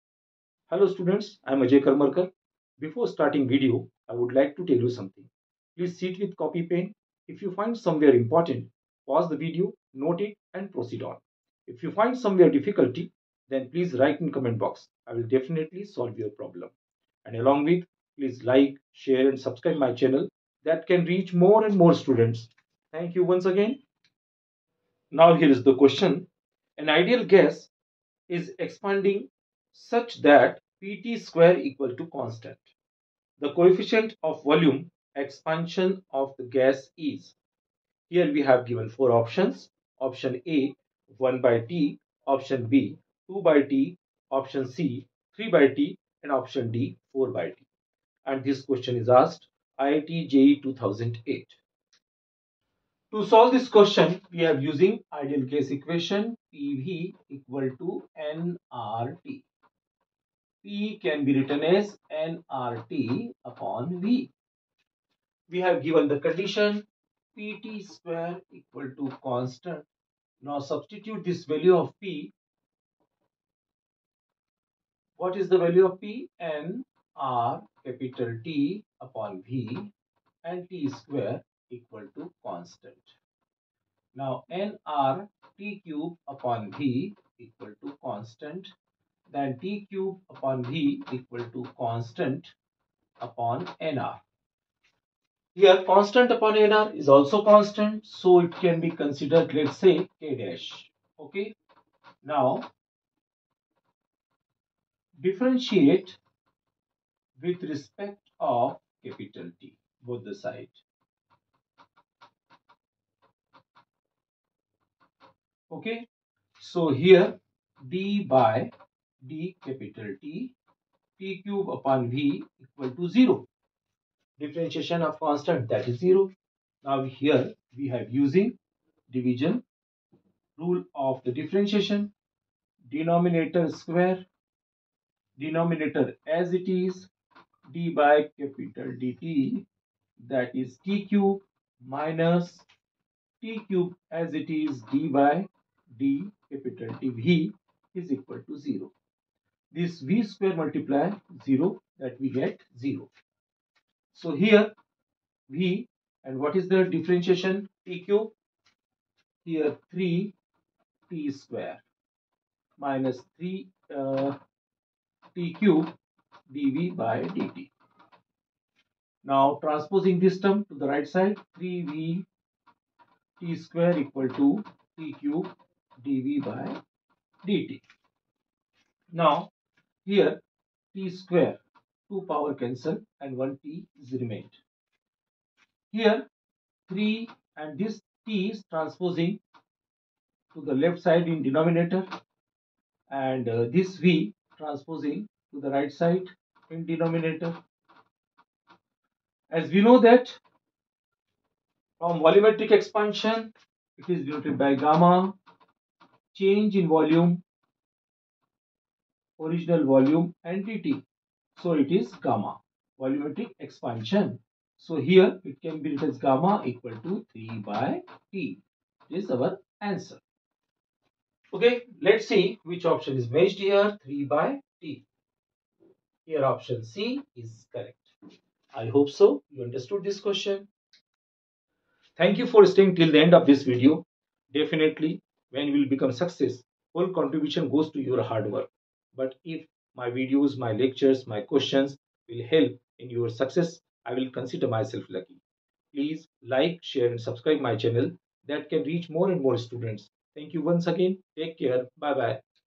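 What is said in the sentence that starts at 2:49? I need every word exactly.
Now transposing this term to the right side 3v t square equal to t cube dv by dt.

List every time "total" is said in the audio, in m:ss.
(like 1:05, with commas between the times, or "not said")
not said.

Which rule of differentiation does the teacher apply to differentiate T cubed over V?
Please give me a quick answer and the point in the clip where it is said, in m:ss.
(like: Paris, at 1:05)
Division rule, at 2:09.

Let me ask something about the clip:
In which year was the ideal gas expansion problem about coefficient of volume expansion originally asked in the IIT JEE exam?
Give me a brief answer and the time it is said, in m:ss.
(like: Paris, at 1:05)
2008, at 0:50.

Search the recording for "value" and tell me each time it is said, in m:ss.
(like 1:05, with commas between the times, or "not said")
1:11, 1:15.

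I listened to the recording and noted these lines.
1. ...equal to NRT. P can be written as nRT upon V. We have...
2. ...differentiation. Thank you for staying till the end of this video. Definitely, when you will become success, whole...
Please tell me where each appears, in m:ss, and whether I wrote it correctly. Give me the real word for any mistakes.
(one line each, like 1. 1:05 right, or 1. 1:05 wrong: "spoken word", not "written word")
1. 0:57 right
2. 3:50 wrong: "question", not "differentiation".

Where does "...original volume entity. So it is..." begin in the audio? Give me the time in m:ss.
3:29.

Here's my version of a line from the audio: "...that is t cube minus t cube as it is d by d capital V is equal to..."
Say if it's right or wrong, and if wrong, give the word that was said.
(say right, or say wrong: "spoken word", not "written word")
right.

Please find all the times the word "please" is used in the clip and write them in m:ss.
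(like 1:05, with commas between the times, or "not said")
0:05, 0:13, 0:18, 4:05.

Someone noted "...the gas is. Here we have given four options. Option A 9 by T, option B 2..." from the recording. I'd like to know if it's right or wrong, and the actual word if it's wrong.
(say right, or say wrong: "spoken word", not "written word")
wrong: "1", not "9".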